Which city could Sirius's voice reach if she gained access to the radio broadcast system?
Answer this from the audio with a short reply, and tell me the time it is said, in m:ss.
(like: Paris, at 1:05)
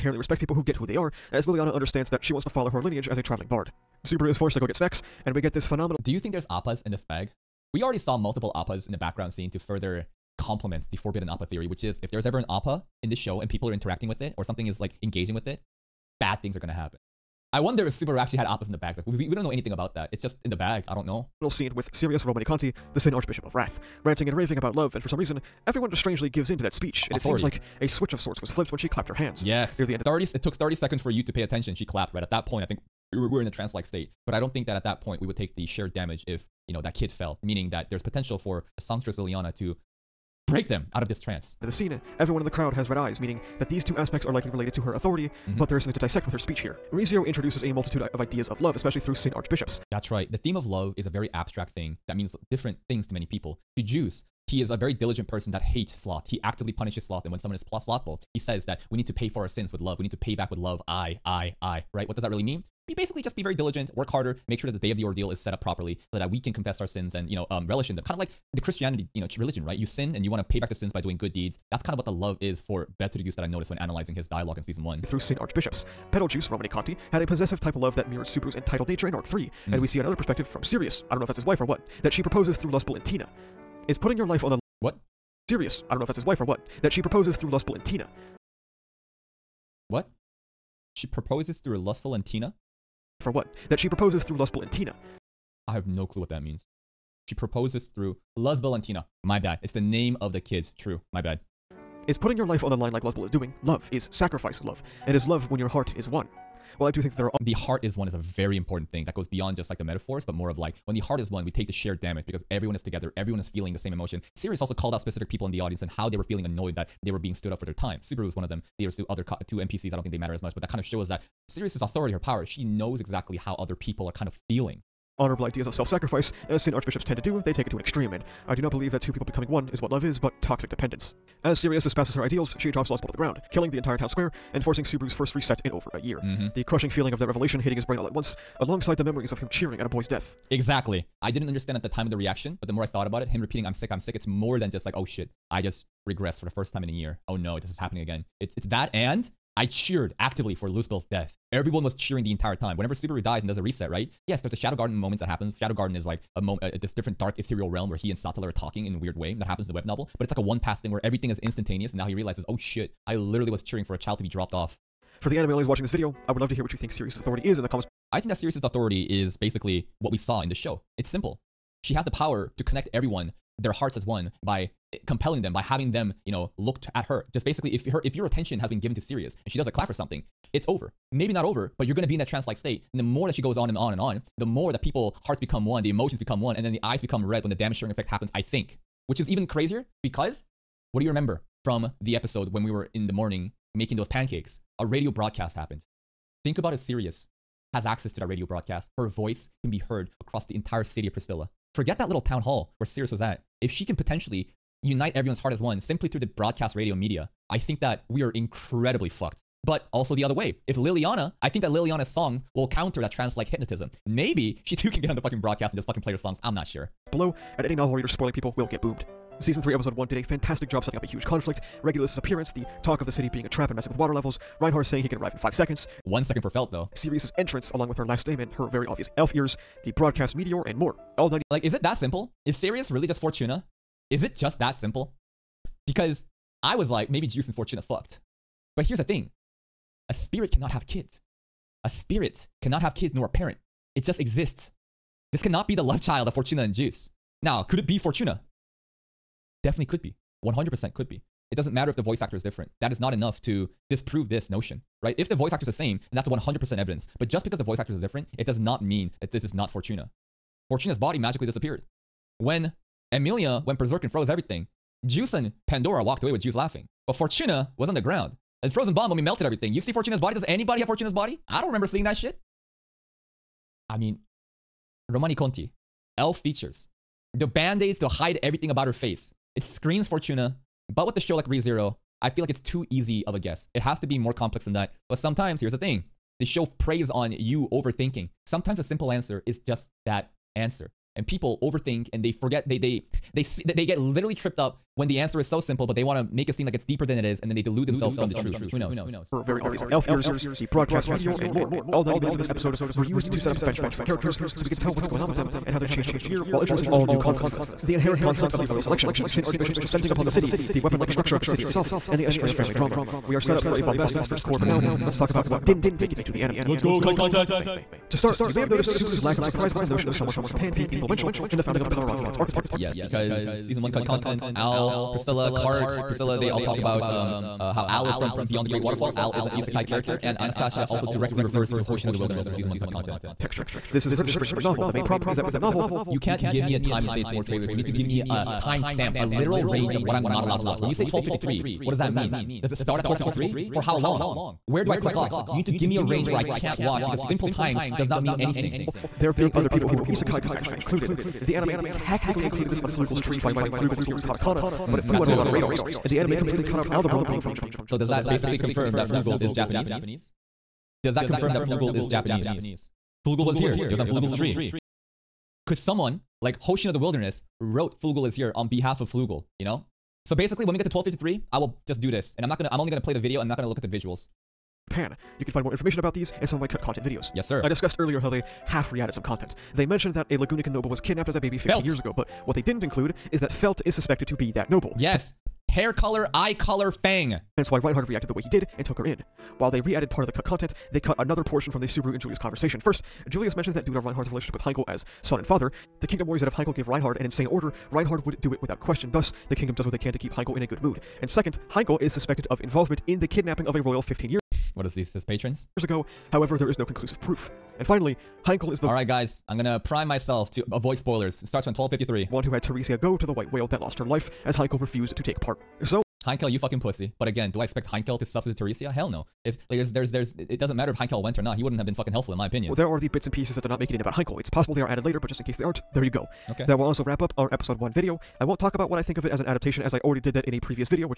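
Pristella, at 3:21.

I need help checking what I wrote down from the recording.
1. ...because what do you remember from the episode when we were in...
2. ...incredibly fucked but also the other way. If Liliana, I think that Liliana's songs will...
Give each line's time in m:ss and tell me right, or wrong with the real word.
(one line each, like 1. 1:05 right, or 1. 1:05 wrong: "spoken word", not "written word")
1. 3:10 right
2. 3:28 right.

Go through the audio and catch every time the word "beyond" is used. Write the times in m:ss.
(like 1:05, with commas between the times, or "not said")
1:49, 5:28.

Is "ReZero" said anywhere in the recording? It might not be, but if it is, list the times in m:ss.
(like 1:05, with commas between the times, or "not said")
0:46, 4:41.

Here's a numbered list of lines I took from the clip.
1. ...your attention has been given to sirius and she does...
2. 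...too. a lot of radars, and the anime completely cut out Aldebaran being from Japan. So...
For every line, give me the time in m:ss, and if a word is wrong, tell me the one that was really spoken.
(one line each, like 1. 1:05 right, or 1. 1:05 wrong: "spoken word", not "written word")
1. 2:58 right
2. 5:55 right.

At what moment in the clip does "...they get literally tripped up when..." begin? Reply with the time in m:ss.
4:53.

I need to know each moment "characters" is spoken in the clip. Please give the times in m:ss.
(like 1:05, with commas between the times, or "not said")
5:04, 5:29.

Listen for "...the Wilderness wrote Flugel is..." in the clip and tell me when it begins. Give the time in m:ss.
6:06.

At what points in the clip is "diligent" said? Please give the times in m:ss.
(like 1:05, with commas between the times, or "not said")
0:54, 1:03.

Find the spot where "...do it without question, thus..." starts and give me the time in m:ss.
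6:38.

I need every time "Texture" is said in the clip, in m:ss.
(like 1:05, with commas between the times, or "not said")
5:33.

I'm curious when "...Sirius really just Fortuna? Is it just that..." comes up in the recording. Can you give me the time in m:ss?
3:52.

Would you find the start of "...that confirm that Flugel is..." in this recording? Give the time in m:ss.
6:01.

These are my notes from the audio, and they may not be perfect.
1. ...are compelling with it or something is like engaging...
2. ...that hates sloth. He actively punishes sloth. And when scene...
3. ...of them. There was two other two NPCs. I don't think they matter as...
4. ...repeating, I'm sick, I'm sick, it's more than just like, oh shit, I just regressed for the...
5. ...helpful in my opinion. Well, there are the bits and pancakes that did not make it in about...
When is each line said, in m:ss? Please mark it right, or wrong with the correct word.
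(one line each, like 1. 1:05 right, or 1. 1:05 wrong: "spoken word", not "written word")
1. 0:13 wrong: "interacting", not "compelling"
2. 0:55 wrong: "someone", not "scene"
3. 1:58 right
4. 2:23 right
5. 7:02 wrong: "pieces", not "pancakes".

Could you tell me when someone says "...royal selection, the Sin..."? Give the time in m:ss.
5:08.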